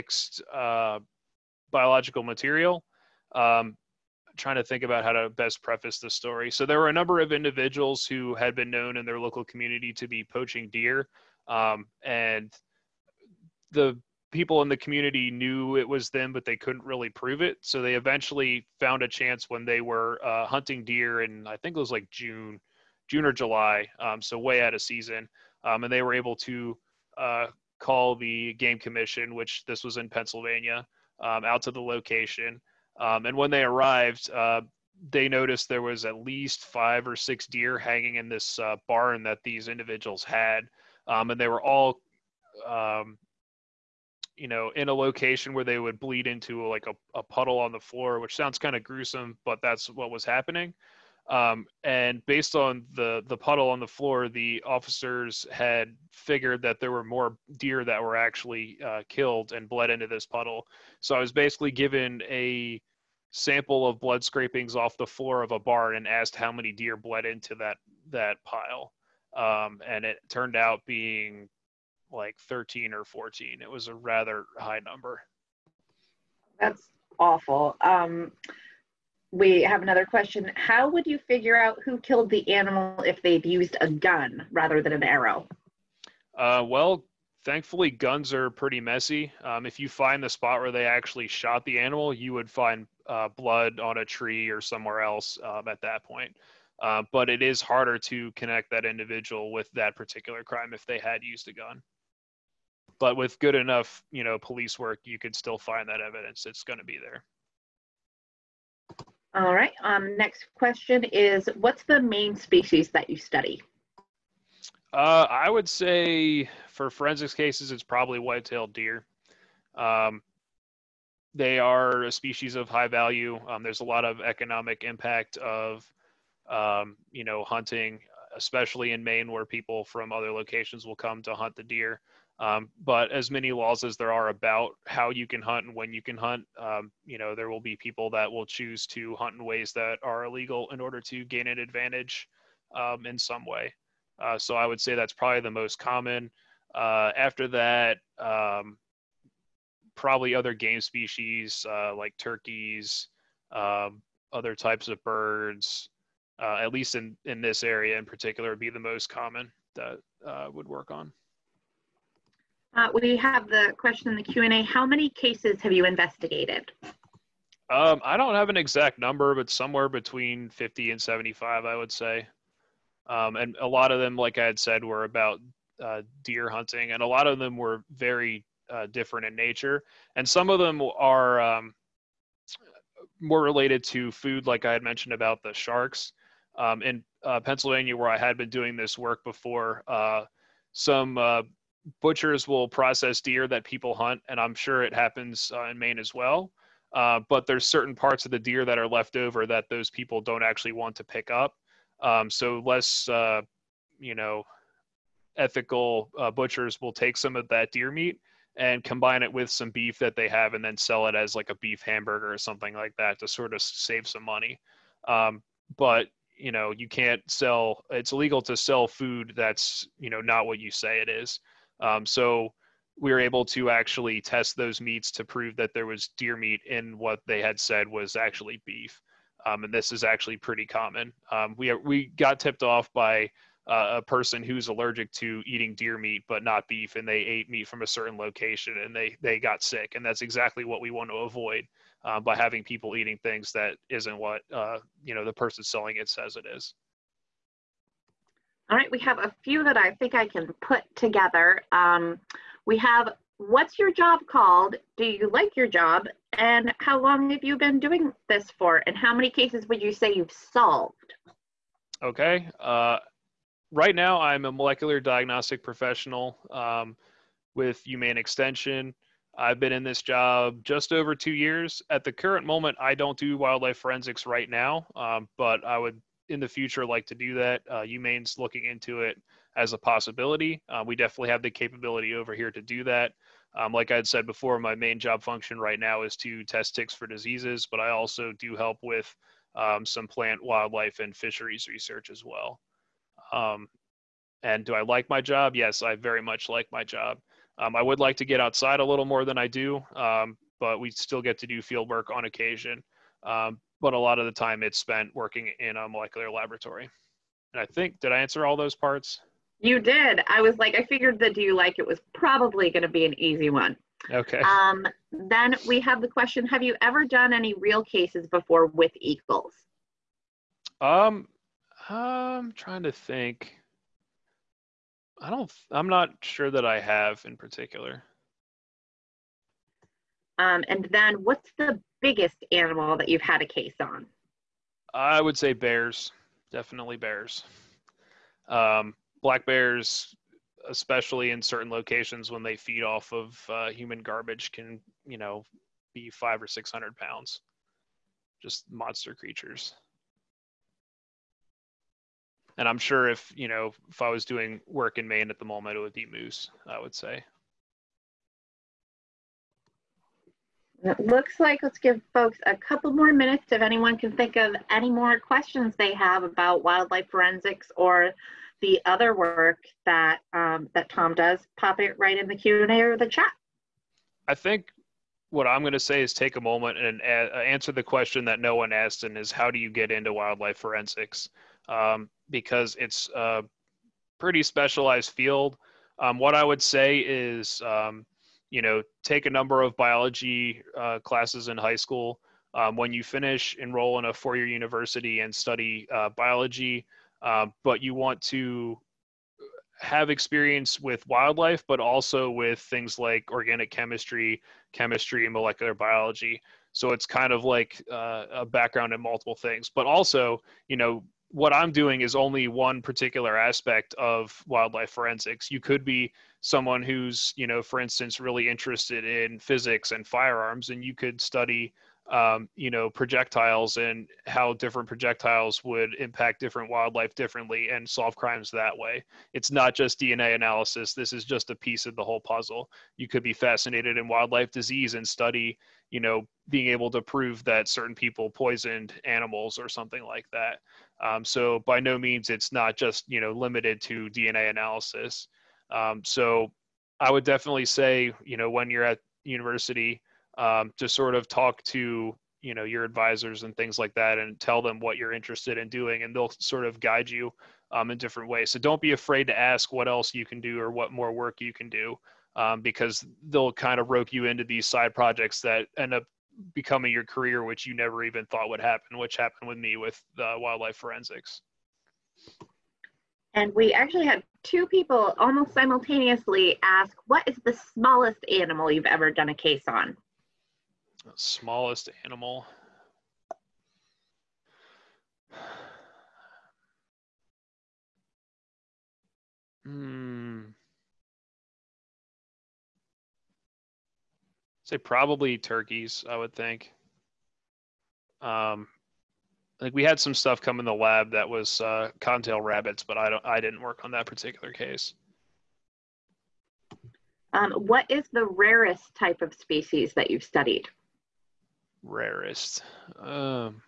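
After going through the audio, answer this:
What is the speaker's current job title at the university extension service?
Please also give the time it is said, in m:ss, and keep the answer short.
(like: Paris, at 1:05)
Molecular diagnostic professional, at 4:24.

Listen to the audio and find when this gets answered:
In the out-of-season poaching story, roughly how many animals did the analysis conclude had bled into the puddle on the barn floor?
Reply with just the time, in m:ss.
1:12.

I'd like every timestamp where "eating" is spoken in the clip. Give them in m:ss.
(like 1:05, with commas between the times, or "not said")
3:55, 4:02.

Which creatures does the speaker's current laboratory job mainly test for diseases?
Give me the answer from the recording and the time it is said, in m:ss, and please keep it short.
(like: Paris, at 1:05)
Ticks, at 4:46.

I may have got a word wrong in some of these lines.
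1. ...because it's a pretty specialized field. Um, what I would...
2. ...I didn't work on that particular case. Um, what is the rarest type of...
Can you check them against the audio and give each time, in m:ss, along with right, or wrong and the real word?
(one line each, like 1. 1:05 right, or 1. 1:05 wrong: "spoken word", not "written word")
1. 6:22 right
2. 8:23 right.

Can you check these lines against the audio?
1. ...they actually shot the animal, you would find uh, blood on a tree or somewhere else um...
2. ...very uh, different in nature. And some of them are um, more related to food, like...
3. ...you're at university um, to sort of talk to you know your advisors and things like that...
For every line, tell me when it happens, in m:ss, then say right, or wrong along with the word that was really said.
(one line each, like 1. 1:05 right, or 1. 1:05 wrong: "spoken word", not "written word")
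1. 1:30 right
2. 2:57 right
3. 7:28 right.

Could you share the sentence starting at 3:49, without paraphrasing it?
Um, and this is actually pretty common.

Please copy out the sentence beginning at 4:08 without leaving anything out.
All right, we have a few that I think I can put together.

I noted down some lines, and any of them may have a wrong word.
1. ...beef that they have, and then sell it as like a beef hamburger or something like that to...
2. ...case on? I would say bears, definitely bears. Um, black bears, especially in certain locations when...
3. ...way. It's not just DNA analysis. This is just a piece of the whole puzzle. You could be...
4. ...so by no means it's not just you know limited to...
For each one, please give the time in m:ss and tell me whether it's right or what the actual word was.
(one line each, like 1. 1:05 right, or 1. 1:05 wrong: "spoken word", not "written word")
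1. 3:29 right
2. 5:33 right
3. 7:08 right
4. 7:21 right.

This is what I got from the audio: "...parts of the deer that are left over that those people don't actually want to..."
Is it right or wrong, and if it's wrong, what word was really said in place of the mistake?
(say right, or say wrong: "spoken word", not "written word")
right.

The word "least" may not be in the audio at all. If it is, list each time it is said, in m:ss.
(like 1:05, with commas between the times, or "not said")
0:36, 2:36.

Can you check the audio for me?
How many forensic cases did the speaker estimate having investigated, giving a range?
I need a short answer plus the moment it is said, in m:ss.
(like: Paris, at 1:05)
50 to 75, at 2:49.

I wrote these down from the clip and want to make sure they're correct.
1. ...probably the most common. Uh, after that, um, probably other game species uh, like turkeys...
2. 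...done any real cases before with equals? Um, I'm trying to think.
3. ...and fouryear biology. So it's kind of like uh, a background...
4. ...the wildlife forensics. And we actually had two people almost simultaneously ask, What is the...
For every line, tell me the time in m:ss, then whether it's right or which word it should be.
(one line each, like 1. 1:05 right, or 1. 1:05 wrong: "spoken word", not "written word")
1. 2:25 right
2. 5:17 right
3. 6:45 wrong: "molecular", not "fouryear"
4. 7:50 right.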